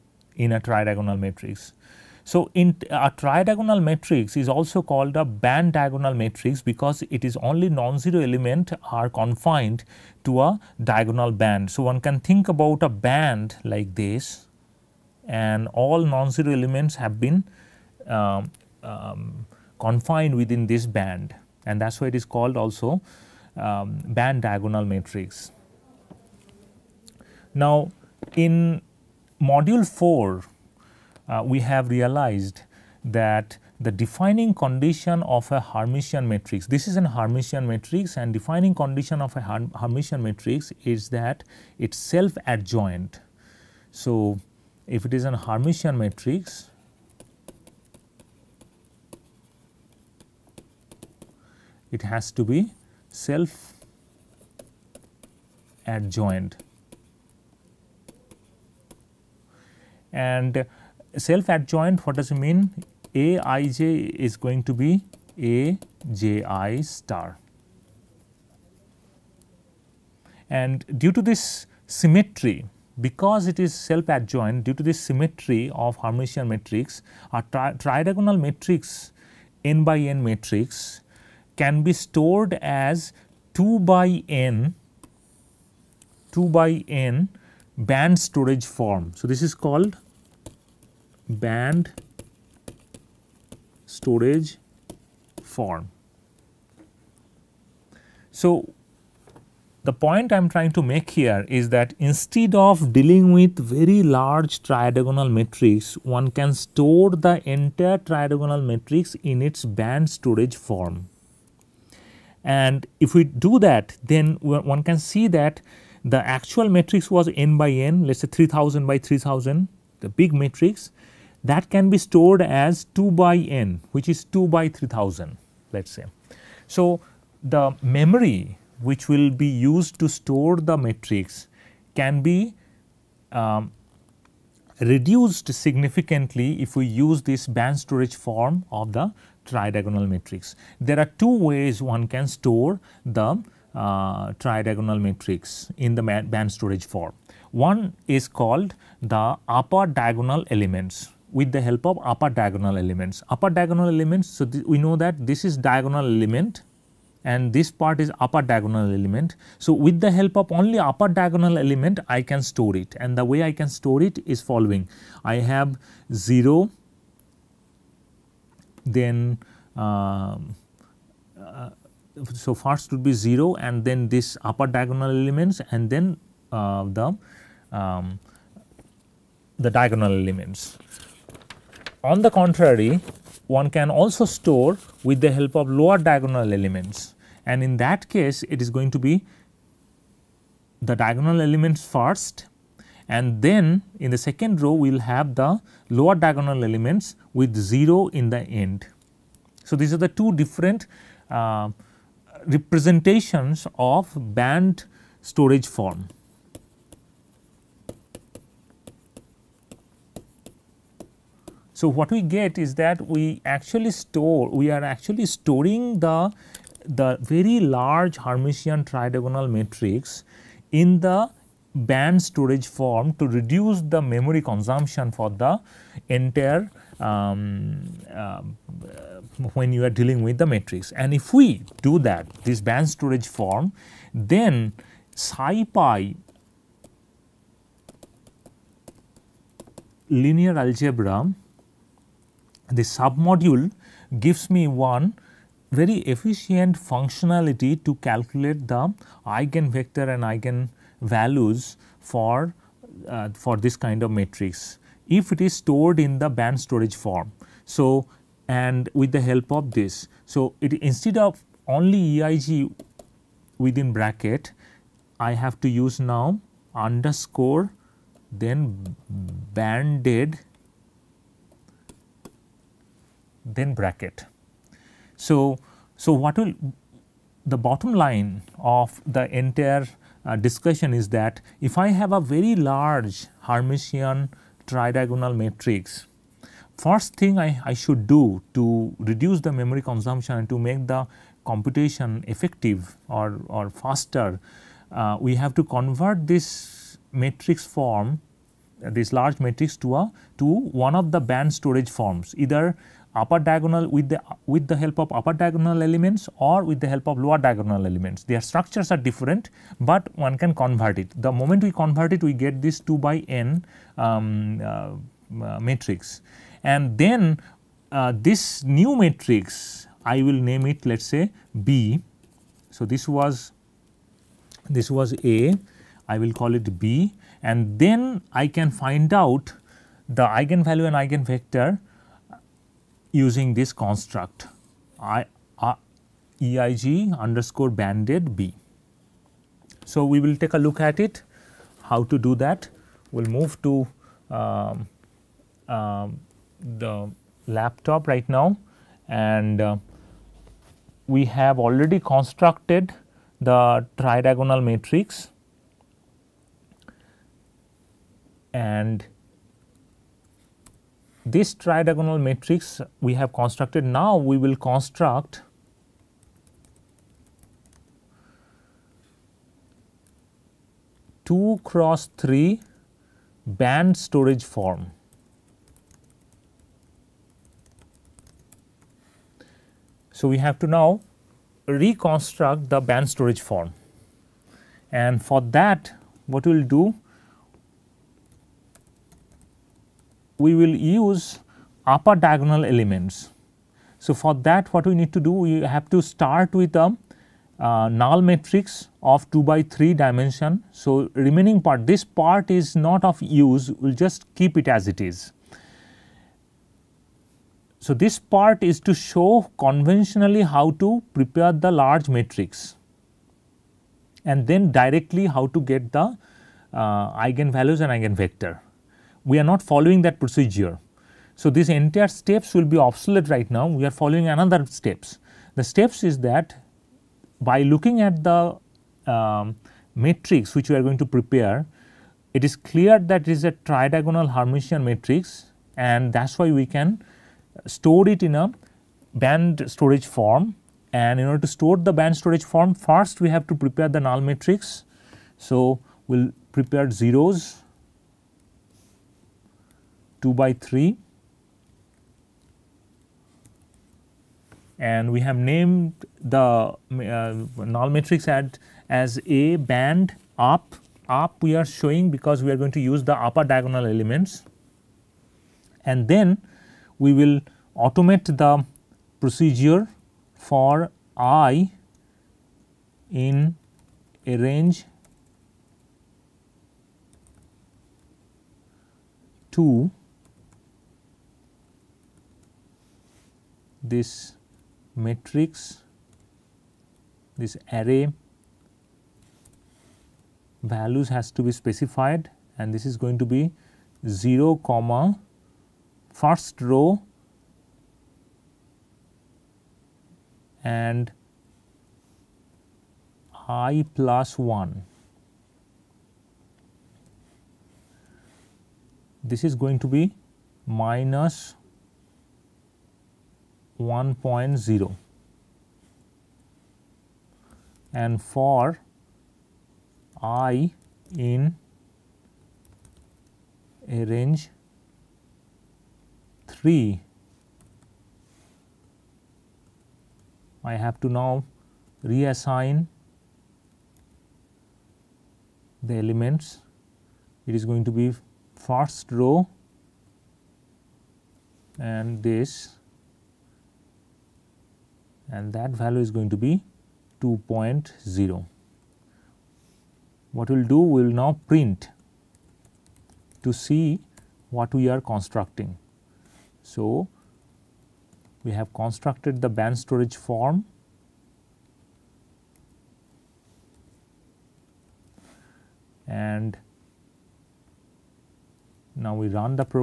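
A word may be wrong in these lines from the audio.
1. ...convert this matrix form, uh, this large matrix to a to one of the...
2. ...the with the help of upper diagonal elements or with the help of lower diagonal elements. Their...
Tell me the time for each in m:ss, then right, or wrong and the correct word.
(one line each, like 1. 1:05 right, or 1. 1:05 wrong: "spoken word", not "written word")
1. 4:55 right
2. 5:04 right.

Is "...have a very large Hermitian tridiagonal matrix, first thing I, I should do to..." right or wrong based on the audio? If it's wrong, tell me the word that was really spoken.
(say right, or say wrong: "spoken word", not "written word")
right.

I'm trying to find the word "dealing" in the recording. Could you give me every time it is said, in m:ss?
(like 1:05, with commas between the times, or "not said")
1:42, 3:49.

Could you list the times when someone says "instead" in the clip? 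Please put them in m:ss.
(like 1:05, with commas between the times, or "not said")
1:41, 4:20.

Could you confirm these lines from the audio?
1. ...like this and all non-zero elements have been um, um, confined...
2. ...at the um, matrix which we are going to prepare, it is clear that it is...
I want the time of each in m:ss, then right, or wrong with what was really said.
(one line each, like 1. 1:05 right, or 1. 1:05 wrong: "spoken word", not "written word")
1. 0:13 right
2. 7:08 right.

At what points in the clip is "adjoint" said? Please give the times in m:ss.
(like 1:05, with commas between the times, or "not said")
0:42, 0:55, 1:01, 1:14.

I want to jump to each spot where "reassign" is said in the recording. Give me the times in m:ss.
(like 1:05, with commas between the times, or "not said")
8:52.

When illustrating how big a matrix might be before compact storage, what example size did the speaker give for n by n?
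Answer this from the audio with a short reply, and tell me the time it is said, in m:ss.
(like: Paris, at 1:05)
3000 by 3000, at 1:58.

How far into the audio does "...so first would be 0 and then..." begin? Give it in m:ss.
2:52.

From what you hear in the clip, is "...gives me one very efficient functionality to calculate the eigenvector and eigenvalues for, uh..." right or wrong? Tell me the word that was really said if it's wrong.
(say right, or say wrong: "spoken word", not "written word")
right.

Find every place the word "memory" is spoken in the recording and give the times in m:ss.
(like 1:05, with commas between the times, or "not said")
2:07, 3:44, 4:49.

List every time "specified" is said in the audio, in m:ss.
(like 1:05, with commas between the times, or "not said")
8:11.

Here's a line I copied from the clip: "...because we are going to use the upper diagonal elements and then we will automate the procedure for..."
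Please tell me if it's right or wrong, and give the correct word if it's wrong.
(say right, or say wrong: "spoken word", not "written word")
right.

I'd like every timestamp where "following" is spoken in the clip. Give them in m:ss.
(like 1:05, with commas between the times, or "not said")
2:44, 6:59, 7:03.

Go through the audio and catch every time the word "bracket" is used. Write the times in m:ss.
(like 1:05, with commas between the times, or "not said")
4:23, 4:33.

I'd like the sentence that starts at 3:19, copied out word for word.
So, these are the two different uh, representations of band storage form.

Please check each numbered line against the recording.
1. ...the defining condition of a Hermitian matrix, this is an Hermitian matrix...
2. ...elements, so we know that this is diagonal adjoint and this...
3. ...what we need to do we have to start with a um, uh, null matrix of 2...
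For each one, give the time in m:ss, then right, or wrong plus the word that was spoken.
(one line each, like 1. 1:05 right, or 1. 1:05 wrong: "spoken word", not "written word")
1. 0:33 right
2. 2:33 wrong: "element", not "adjoint"
3. 6:34 right.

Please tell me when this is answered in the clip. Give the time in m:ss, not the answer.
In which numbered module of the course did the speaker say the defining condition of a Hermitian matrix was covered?
0:29.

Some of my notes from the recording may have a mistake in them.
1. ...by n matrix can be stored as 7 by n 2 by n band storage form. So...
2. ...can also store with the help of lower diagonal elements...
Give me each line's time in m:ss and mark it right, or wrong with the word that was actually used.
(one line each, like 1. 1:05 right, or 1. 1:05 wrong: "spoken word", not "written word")
1. 1:19 wrong: "2", not "7"
2. 3:03 right.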